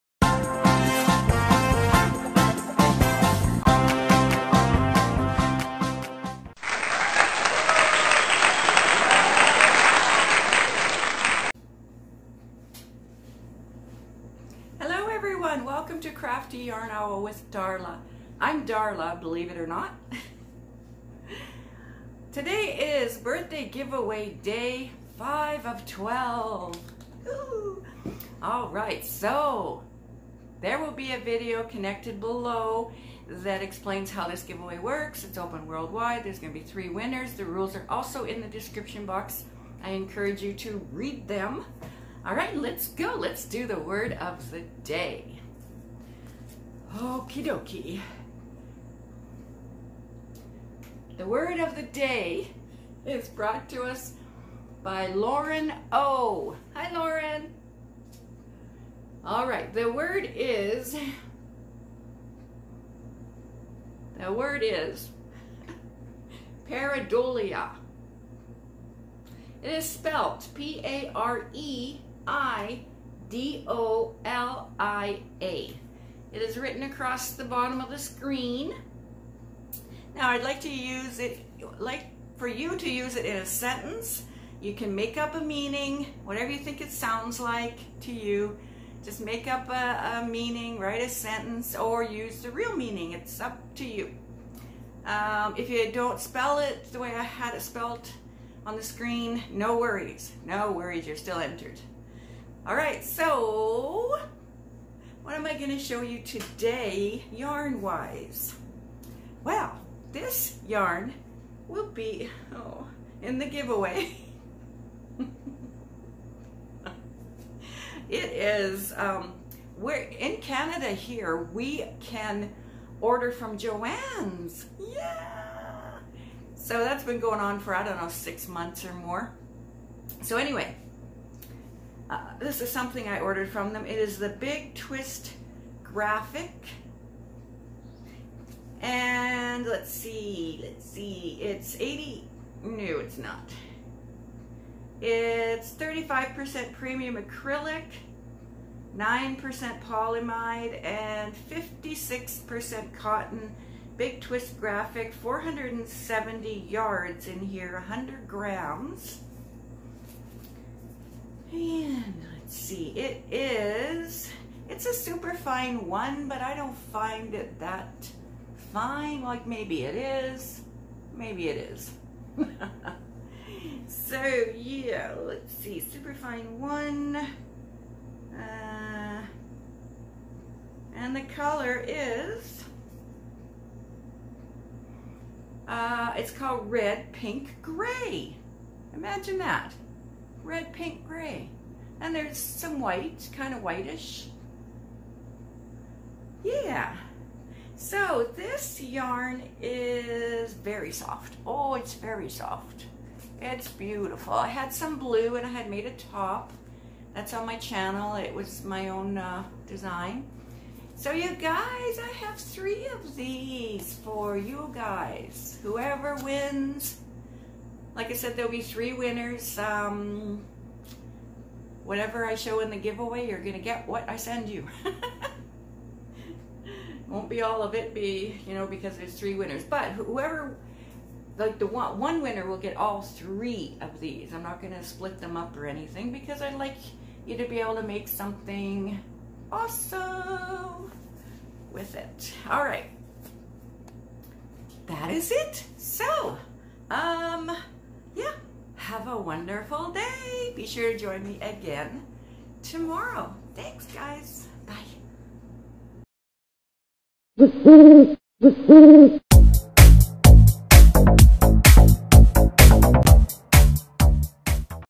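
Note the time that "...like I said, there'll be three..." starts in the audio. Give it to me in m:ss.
3:37.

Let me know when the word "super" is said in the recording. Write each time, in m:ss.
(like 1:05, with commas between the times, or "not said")
2:44, 2:55.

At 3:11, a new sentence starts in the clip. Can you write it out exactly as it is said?
And there's some white, kind of whitish.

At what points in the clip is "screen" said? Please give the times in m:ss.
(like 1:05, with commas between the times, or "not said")
1:17, 1:38.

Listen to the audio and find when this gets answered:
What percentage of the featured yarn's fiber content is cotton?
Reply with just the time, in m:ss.
2:31.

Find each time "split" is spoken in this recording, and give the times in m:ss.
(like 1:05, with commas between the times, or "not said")
3:54.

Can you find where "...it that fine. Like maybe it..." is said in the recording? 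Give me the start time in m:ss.
2:47.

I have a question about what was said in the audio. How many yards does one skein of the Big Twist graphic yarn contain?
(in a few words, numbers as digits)
470 yards.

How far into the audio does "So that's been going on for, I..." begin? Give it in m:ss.
2:06.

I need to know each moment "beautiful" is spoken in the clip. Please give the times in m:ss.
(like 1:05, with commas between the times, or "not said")
3:23.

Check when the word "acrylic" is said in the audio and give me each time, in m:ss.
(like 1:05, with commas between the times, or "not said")
2:27.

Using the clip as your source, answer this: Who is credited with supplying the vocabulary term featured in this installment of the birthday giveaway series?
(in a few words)
Lauren O.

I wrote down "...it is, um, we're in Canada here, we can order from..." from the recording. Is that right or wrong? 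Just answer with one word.
right.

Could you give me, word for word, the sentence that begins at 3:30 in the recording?
So you guys, I have three of these for you guys.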